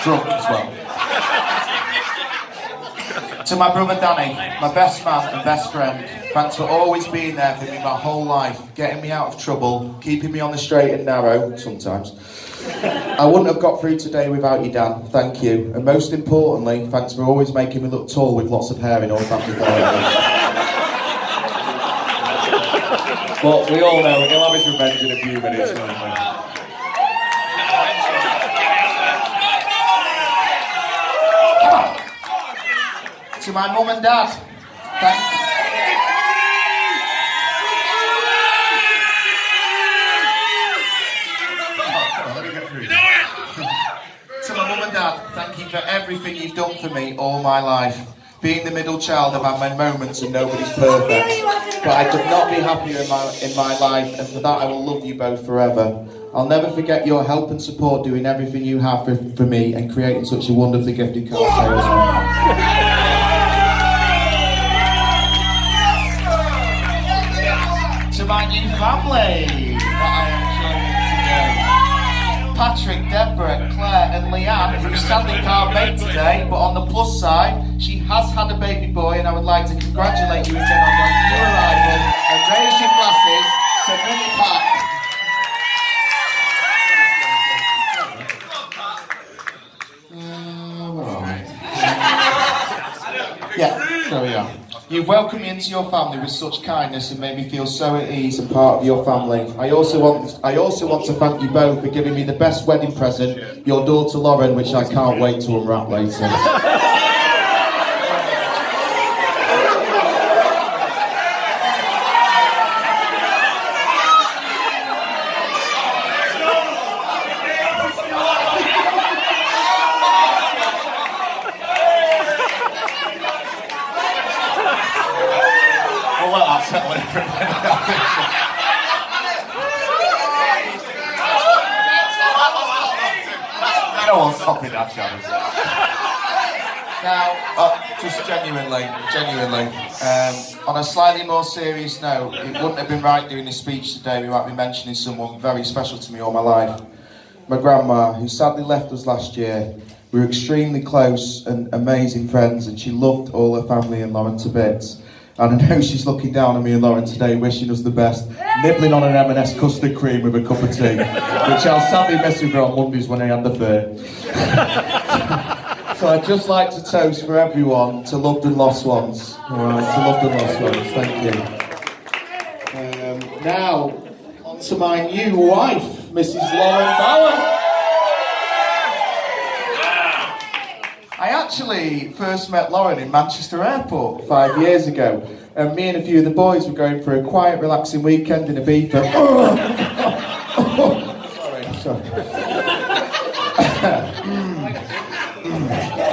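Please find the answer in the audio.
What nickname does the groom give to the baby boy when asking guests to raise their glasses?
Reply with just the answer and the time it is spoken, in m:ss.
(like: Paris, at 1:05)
Mini Pat, at 1:23.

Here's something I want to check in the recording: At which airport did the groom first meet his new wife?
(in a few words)
Manchester Airport.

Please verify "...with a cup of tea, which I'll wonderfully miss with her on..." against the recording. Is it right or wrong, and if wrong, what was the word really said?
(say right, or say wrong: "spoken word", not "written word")
wrong: "sadly", not "wonderfully".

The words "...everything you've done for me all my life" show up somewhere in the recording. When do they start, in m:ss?
0:45.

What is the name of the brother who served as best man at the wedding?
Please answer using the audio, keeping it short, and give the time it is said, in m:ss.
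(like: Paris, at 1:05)
Danny, at 0:03.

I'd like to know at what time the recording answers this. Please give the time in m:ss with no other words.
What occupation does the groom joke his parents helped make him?
1:01.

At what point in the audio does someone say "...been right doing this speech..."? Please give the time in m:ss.
2:22.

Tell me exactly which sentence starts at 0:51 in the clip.
But I could not be happier in my, in my life, and for that I will love you both forever.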